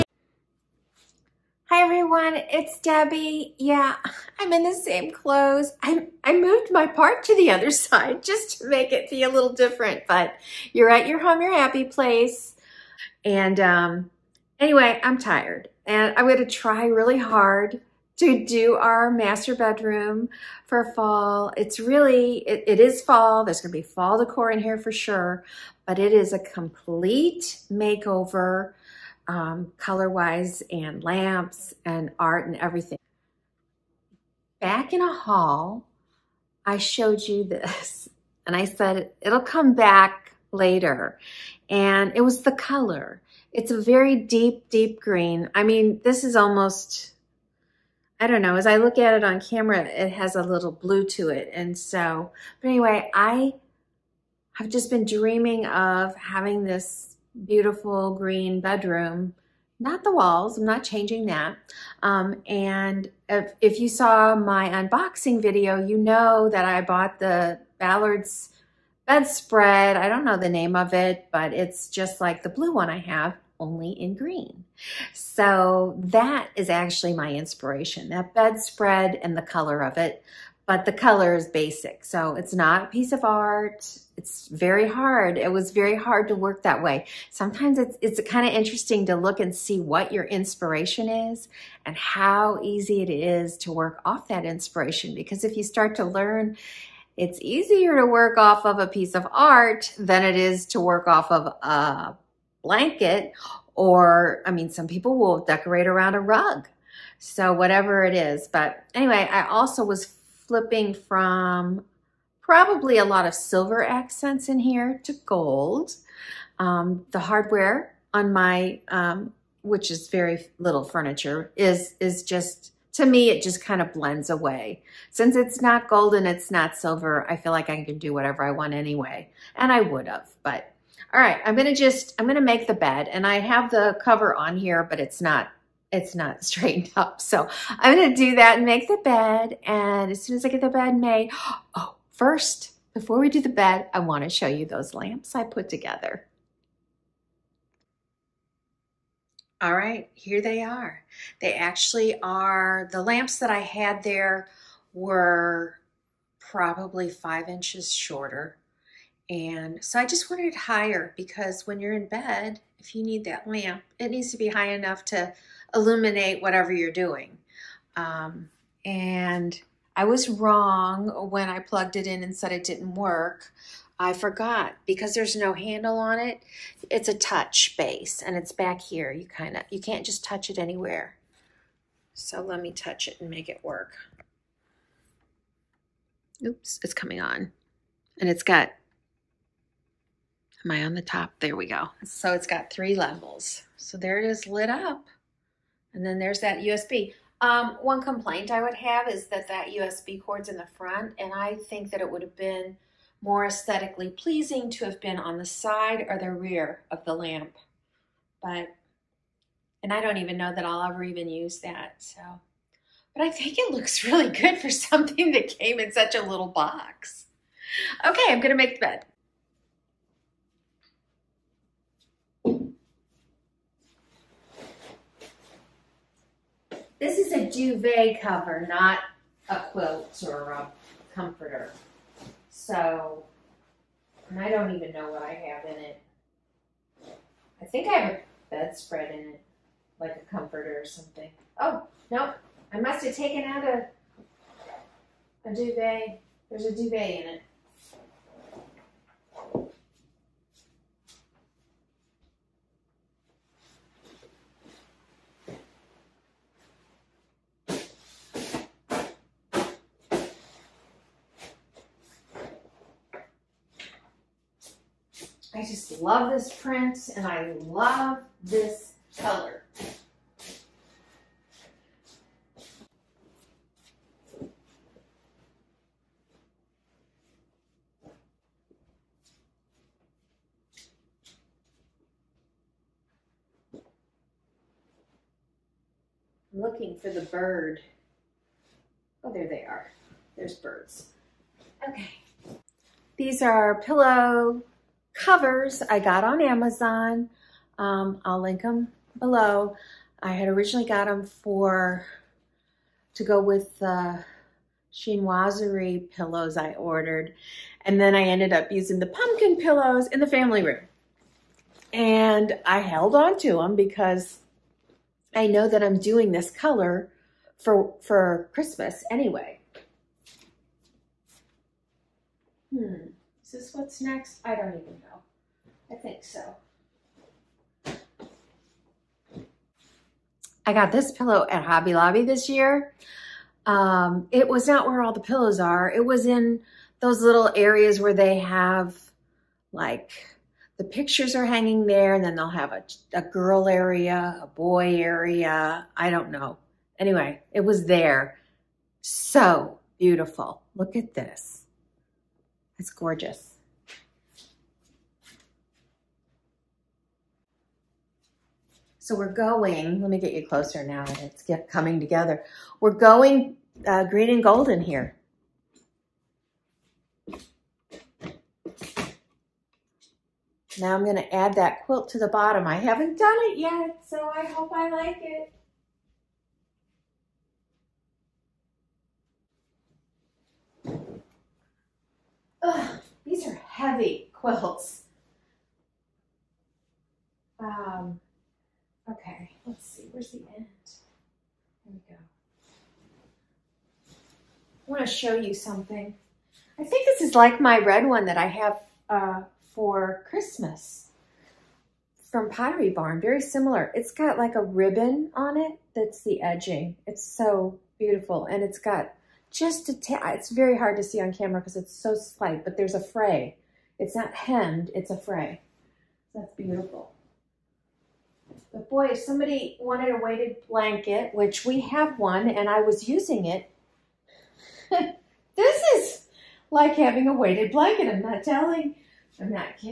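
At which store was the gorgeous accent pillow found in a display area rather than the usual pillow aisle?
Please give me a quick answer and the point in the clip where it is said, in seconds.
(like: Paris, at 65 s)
Hobby Lobby, at 331 s.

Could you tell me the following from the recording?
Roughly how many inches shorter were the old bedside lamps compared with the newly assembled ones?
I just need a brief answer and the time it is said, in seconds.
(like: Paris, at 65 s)
5, at 157 s.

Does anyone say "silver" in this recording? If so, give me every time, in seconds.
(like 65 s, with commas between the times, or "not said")
113 s, 126 s.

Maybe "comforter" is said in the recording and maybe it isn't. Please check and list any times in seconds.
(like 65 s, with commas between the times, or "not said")
231 s, 240 s.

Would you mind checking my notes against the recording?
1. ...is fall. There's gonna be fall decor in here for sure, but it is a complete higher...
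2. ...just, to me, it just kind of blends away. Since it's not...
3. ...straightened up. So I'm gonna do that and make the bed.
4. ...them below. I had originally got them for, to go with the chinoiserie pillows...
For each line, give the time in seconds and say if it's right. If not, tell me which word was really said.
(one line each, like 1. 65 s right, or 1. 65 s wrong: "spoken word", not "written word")
1. 22 s wrong: "makeover", not "higher"
2. 122 s right
3. 136 s right
4. 298 s right.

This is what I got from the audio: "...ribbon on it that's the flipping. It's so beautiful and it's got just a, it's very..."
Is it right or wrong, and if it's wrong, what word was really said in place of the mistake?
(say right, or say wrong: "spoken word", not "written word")
wrong: "edging", not "flipping".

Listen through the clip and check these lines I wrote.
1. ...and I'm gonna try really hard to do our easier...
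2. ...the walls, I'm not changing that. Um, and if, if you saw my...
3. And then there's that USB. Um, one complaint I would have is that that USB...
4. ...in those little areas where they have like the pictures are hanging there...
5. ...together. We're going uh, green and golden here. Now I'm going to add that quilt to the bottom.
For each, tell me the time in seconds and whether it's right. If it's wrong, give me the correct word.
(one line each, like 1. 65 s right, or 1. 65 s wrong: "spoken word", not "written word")
1. 15 s wrong: "master", not "easier"
2. 60 s right
3. 195 s right
4. 336 s right
5. 362 s right.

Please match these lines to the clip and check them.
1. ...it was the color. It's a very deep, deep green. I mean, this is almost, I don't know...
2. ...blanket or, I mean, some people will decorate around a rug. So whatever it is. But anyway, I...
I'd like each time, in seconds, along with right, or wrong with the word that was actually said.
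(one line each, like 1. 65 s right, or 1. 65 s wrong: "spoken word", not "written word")
1. 42 s right
2. 102 s right.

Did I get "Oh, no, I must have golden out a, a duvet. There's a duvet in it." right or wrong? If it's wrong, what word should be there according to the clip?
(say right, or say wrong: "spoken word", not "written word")
wrong: "taken", not "golden".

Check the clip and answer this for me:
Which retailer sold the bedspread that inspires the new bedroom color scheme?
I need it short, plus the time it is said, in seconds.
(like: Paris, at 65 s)
Ballard's, at 67 s.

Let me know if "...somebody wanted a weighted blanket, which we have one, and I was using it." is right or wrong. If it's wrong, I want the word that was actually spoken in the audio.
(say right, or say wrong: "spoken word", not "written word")
right.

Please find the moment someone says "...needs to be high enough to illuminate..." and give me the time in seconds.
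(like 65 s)
164 s.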